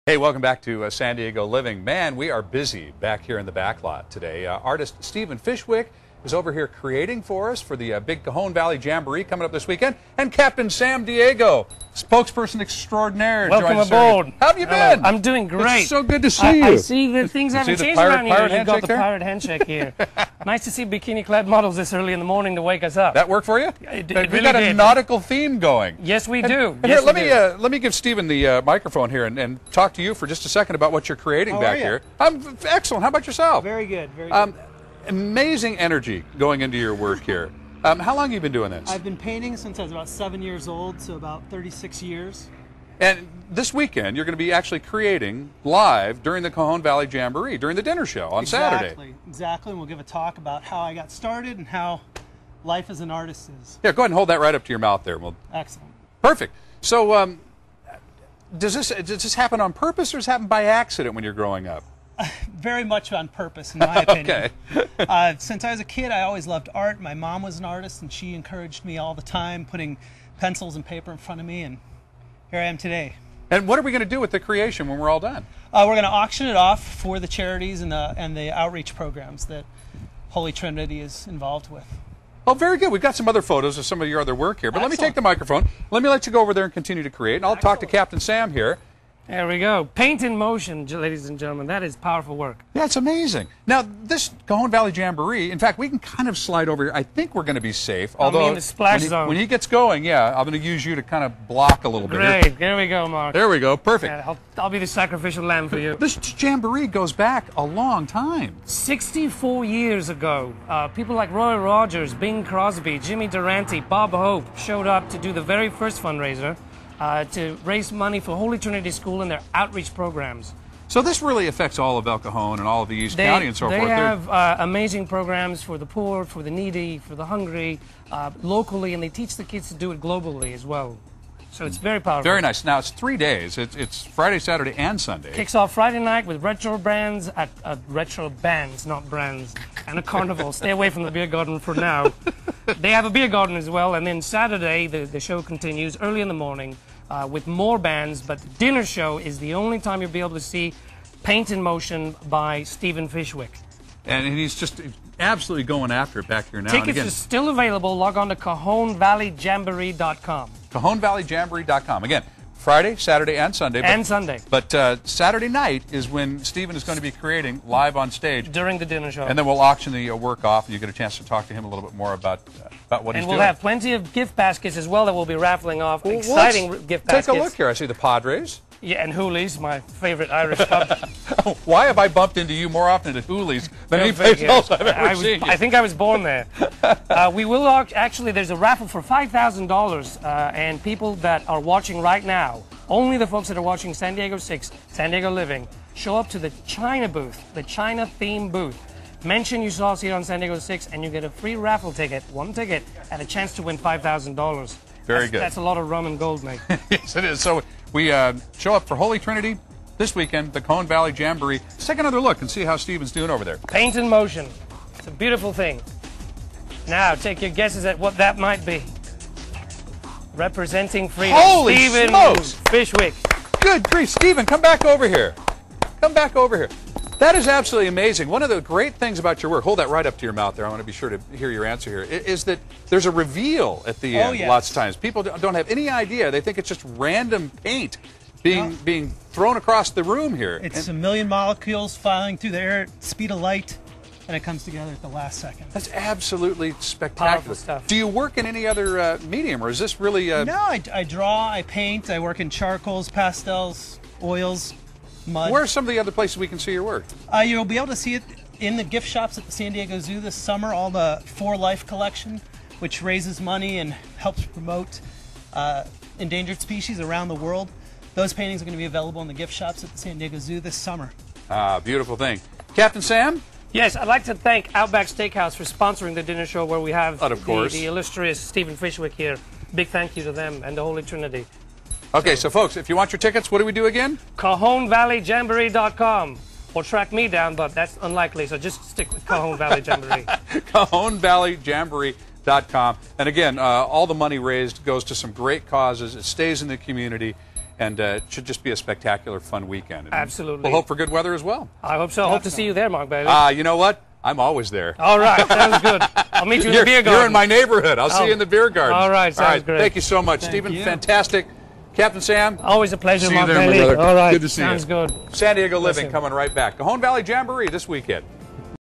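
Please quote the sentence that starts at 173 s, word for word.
And we'll have plenty of gift baskets as well that we'll be raffling off.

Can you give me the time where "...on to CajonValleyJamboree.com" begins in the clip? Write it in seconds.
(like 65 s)
158 s.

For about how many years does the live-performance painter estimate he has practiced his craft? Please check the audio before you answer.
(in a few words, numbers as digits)
36 years.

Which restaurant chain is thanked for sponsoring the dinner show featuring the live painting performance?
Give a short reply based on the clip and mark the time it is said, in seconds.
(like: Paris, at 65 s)
Outback Steakhouse, at 274 s.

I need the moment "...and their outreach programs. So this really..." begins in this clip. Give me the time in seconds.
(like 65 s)
119 s.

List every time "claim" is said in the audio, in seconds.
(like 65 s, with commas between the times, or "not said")
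not said.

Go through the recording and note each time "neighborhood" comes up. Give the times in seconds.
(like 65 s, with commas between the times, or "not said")
307 s.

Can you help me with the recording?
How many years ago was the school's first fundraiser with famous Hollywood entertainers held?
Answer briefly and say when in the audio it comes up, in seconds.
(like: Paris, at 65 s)
64, at 108 s.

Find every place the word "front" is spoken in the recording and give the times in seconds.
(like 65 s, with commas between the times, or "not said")
71 s.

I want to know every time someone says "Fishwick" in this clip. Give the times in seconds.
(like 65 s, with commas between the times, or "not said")
5 s, 153 s, 222 s, 278 s.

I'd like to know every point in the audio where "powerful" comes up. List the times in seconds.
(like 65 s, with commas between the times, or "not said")
91 s, 131 s.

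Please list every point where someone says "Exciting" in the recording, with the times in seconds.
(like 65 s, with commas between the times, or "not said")
176 s.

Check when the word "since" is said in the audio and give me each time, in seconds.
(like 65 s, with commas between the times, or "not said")
39 s, 65 s.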